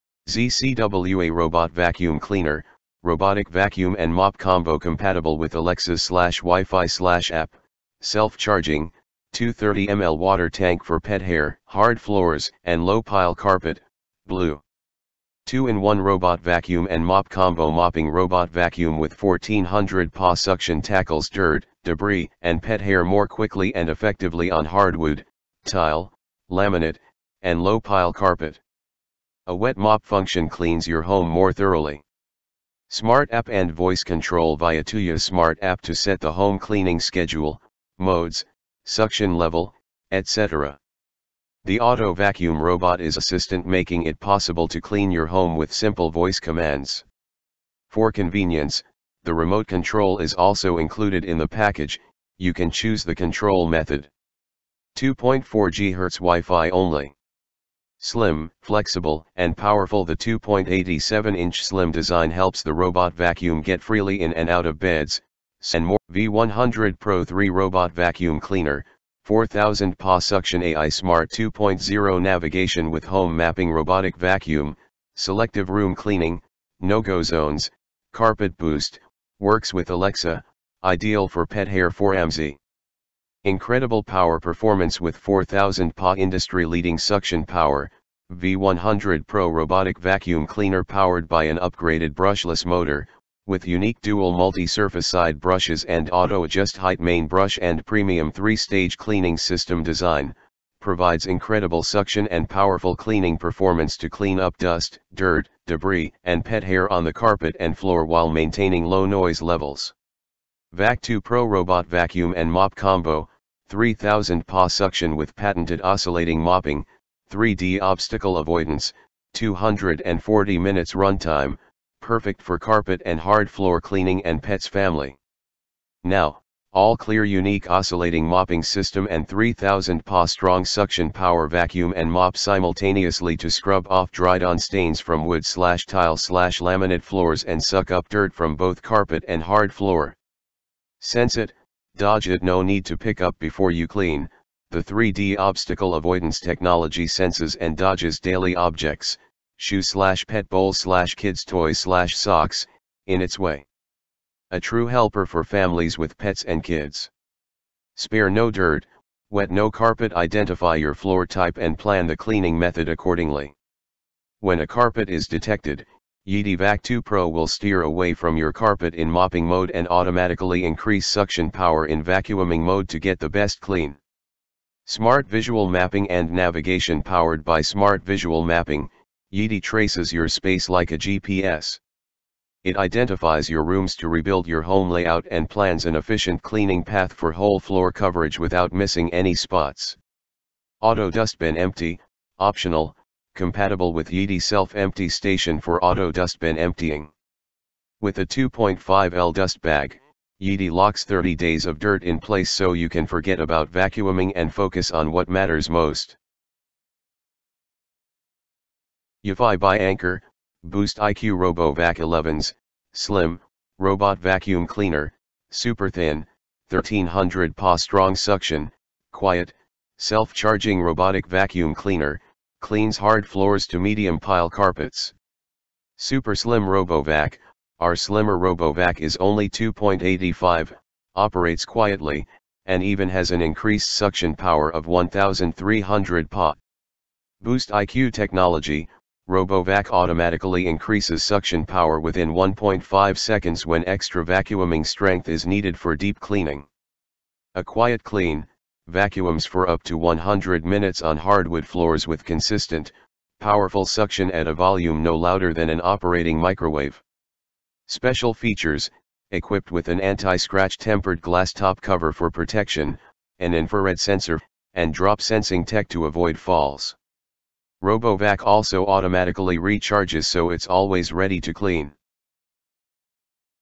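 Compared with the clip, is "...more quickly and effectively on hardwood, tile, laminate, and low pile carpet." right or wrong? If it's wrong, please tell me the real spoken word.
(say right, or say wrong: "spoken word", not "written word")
right.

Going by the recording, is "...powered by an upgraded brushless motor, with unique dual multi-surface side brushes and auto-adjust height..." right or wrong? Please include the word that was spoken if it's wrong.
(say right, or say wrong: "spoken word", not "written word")
right.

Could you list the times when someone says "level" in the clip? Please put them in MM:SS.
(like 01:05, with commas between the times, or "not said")
00:39, 01:49.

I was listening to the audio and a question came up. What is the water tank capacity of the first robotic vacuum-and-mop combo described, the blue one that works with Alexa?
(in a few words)
230 ml.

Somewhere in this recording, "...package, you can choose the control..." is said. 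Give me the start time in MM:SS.
00:51.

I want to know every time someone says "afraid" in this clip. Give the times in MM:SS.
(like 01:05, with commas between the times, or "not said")
not said.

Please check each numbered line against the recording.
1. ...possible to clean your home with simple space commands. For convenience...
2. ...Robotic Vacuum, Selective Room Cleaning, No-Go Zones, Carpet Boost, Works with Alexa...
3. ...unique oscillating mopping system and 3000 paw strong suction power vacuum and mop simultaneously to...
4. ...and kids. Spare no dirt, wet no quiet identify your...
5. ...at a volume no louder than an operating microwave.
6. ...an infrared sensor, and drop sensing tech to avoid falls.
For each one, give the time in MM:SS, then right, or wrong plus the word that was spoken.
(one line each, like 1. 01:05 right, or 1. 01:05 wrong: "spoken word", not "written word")
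1. 00:44 wrong: "voice", not "space"
2. 01:13 right
3. 02:07 right
4. 02:36 wrong: "carpet", not "quiet"
5. 04:14 right
6. 04:23 right.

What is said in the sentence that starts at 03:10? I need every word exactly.
Auto dustbin empty, optional, compatible with Yeedi self-empty station for auto dustbin emptying.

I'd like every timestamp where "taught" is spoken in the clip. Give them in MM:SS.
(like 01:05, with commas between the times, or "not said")
not said.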